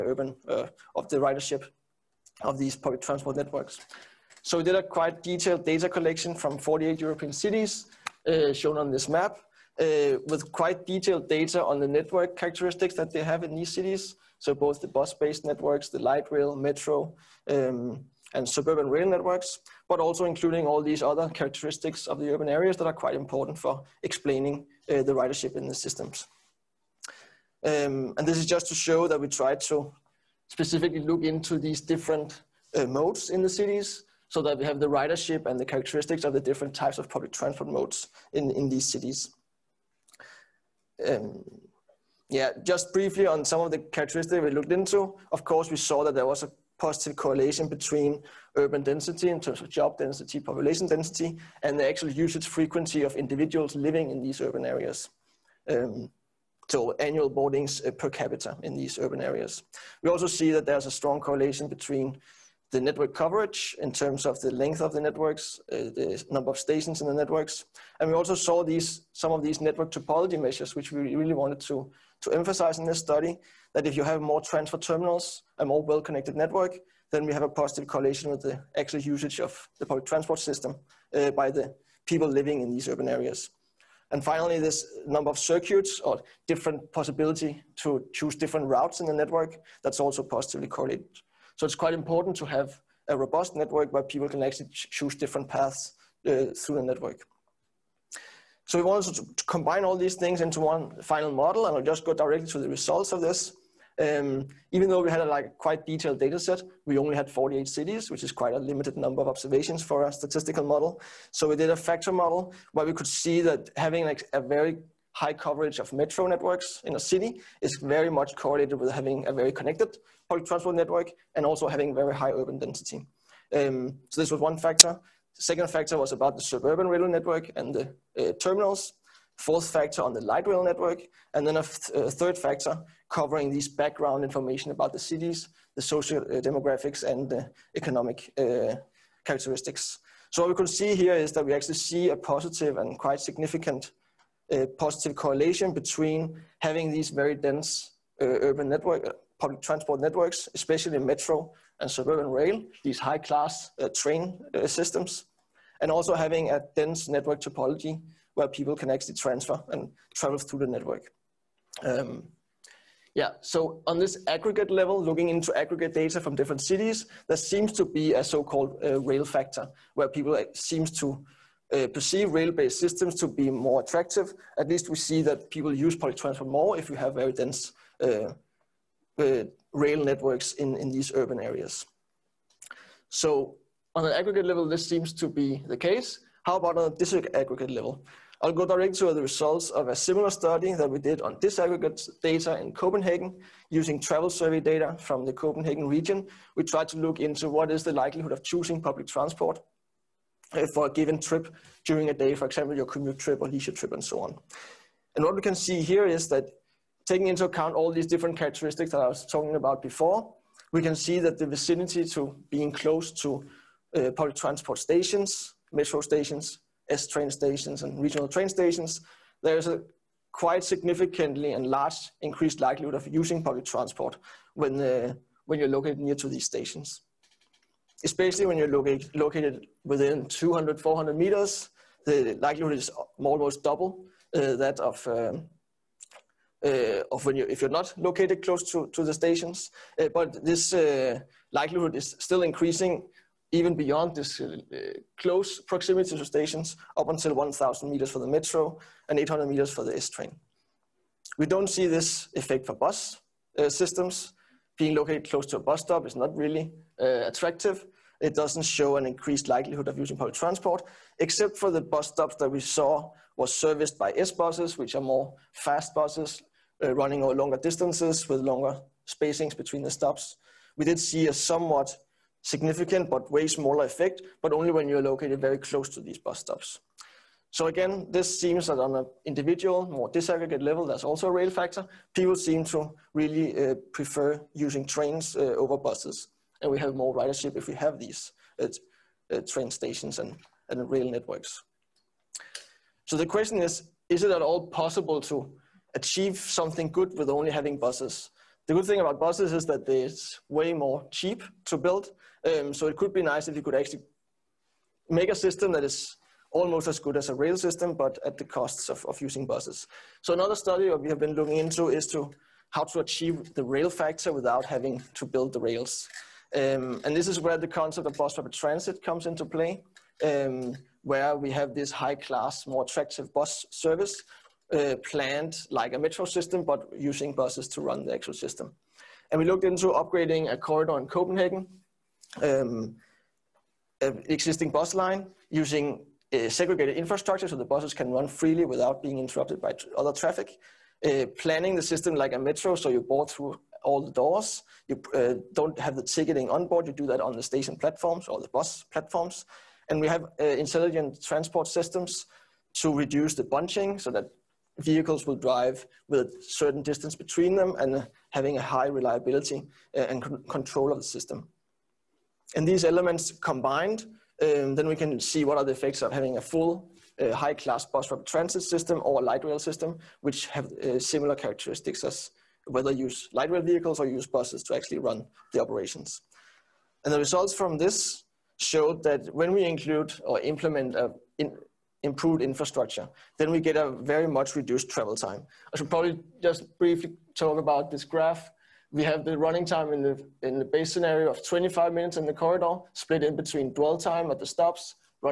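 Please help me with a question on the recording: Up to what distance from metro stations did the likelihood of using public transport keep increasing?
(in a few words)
1,000 meters.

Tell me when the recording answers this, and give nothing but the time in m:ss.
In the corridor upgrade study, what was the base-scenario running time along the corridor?
6:31.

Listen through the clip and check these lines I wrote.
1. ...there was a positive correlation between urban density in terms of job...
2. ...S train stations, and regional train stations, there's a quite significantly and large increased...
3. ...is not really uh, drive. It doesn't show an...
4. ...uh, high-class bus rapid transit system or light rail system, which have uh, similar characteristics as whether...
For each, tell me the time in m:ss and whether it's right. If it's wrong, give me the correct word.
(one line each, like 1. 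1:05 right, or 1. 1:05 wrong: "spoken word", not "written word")
1. 0:46 right
2. 3:36 right
3. 4:16 wrong: "attractive", not "drive"
4. 6:07 right.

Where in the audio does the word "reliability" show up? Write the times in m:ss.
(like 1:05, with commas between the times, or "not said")
5:58.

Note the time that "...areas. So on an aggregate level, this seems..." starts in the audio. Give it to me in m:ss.
3:01.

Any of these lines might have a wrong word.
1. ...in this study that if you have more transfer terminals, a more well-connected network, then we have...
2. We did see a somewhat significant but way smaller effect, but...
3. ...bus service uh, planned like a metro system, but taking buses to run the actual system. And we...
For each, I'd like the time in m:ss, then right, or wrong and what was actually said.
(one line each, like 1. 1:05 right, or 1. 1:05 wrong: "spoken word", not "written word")
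1. 1:12 right
2. 4:30 right
3. 5:23 wrong: "using", not "taking".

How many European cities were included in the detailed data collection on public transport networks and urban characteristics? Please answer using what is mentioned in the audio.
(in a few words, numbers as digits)
48.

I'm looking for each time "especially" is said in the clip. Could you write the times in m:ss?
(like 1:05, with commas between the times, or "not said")
2:30, 3:48.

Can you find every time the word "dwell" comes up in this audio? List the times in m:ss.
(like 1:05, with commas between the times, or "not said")
6:33.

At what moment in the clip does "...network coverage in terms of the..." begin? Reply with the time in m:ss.
1:02.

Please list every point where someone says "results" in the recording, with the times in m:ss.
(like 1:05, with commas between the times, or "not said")
1:42, 3:09, 6:17.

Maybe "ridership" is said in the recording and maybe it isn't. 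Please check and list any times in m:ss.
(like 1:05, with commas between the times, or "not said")
0:01, 0:25, 0:34, 4:47.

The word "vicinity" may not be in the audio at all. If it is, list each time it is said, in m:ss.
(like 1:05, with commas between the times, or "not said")
3:31.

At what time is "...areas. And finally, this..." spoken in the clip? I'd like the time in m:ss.
1:23.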